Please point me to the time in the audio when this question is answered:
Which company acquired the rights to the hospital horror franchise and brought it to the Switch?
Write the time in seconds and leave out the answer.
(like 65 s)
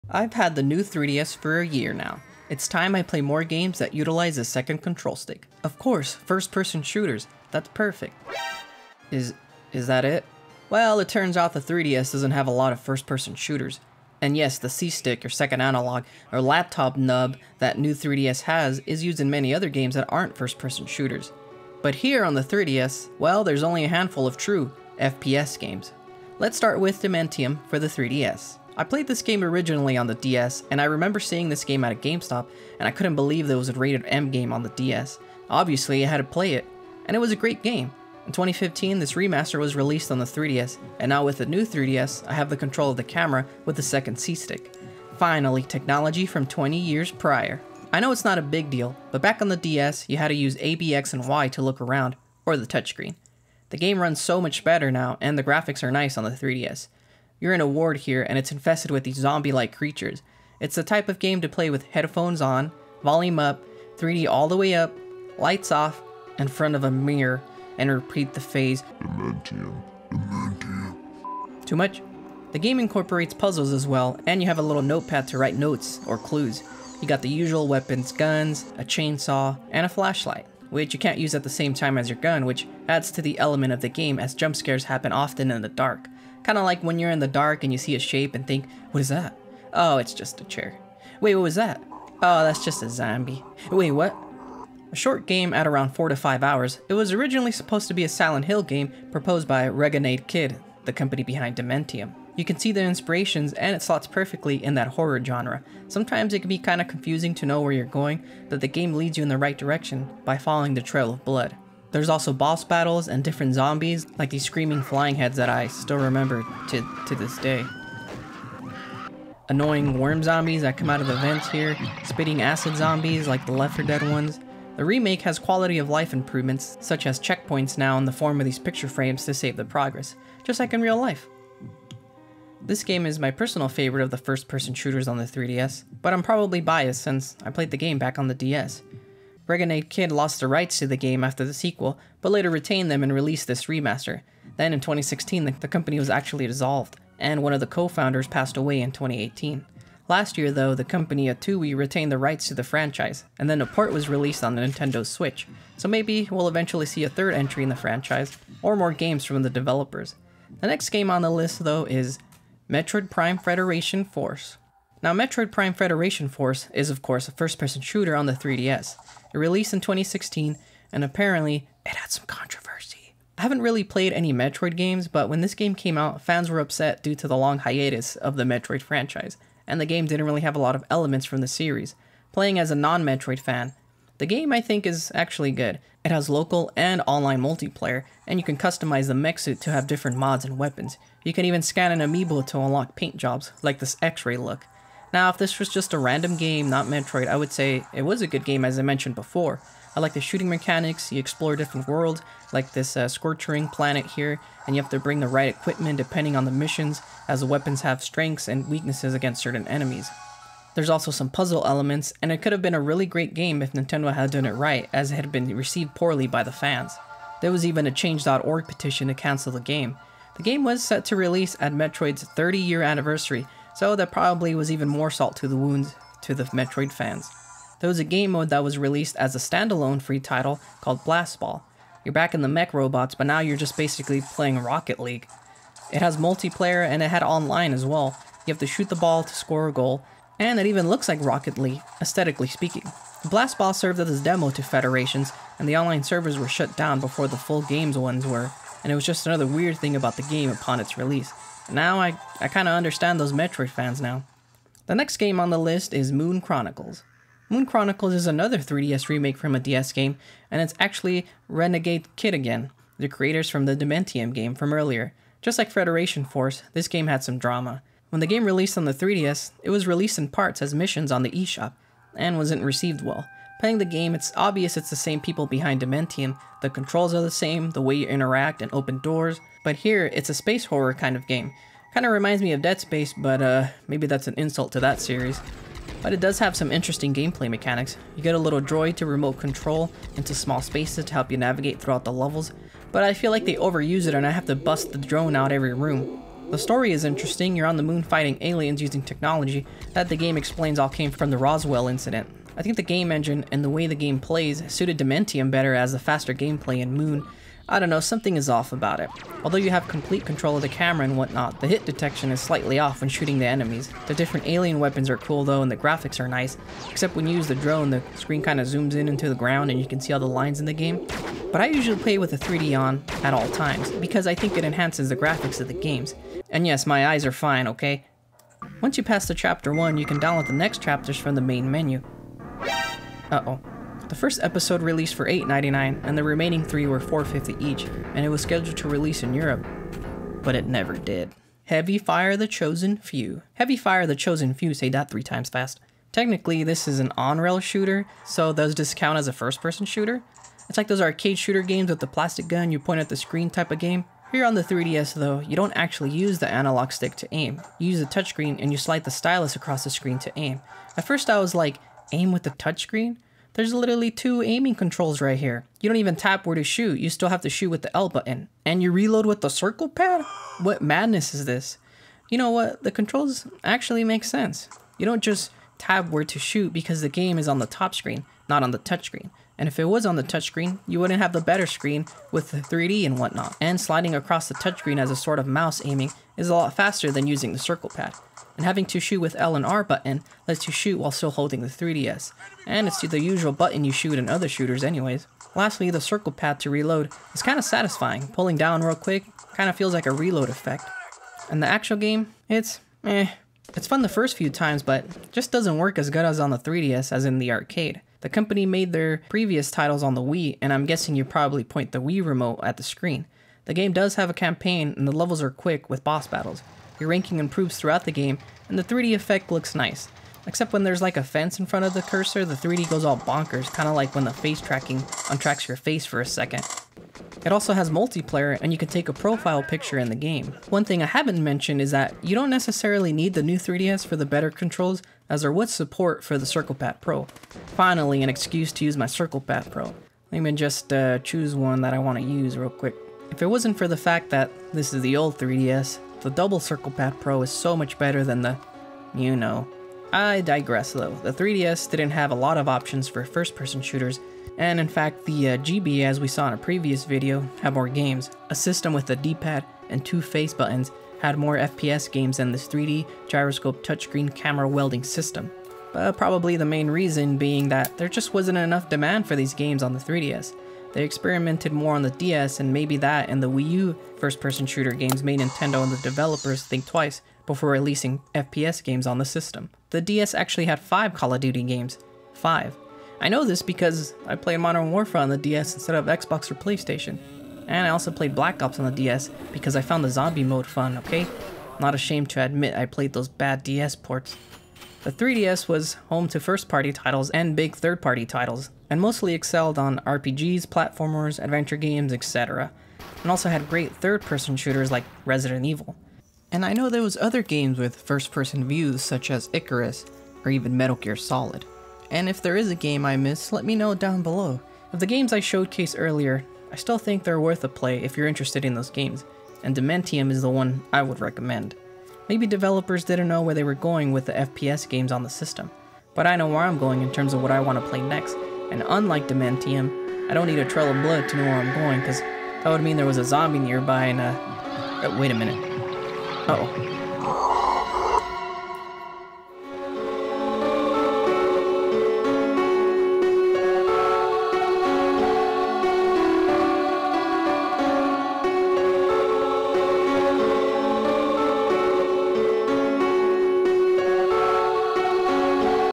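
151 s.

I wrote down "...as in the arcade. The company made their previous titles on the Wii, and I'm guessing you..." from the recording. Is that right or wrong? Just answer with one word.
right.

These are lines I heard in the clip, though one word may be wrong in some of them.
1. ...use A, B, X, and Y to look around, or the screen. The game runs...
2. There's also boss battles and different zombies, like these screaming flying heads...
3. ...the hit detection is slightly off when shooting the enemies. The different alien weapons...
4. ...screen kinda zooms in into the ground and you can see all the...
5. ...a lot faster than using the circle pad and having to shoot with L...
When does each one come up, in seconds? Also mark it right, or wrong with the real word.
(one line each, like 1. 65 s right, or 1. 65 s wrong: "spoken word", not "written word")
1. 50 s wrong: "touchscreen", not "screen"
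2. 111 s right
3. 311 s right
4. 318 s right
5. 386 s right.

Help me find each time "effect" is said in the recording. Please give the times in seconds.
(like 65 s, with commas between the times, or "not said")
400 s, 419 s.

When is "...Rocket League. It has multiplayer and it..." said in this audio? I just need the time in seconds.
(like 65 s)
234 s.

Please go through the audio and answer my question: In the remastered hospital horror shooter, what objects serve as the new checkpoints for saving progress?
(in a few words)
picture frames.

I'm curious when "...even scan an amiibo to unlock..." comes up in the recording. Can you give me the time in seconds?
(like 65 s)
191 s.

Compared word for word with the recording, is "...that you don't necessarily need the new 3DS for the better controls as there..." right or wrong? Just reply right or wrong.
right.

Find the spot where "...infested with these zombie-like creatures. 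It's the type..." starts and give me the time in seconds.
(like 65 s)
58 s.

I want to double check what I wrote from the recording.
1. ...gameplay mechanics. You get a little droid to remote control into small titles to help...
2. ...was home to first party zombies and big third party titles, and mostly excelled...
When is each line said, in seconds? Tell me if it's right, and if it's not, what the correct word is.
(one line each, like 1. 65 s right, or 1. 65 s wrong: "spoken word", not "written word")
1. 287 s wrong: "spaces", not "titles"
2. 495 s wrong: "titles", not "zombies".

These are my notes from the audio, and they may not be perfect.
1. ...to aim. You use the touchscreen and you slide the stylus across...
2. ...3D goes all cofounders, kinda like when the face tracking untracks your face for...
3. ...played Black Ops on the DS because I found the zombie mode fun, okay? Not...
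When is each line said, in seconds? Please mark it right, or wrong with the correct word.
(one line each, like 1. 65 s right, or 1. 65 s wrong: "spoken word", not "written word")
1. 357 s right
2. 422 s wrong: "bonkers", not "cofounders"
3. 488 s right.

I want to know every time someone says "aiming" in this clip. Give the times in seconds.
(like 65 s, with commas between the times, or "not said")
364 s, 385 s.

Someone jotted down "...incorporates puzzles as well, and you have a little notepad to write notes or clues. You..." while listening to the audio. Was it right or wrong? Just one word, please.
right.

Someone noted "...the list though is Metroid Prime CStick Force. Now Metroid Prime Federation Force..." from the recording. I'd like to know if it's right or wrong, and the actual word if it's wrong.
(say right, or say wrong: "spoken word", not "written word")
wrong: "Federation", not "CStick".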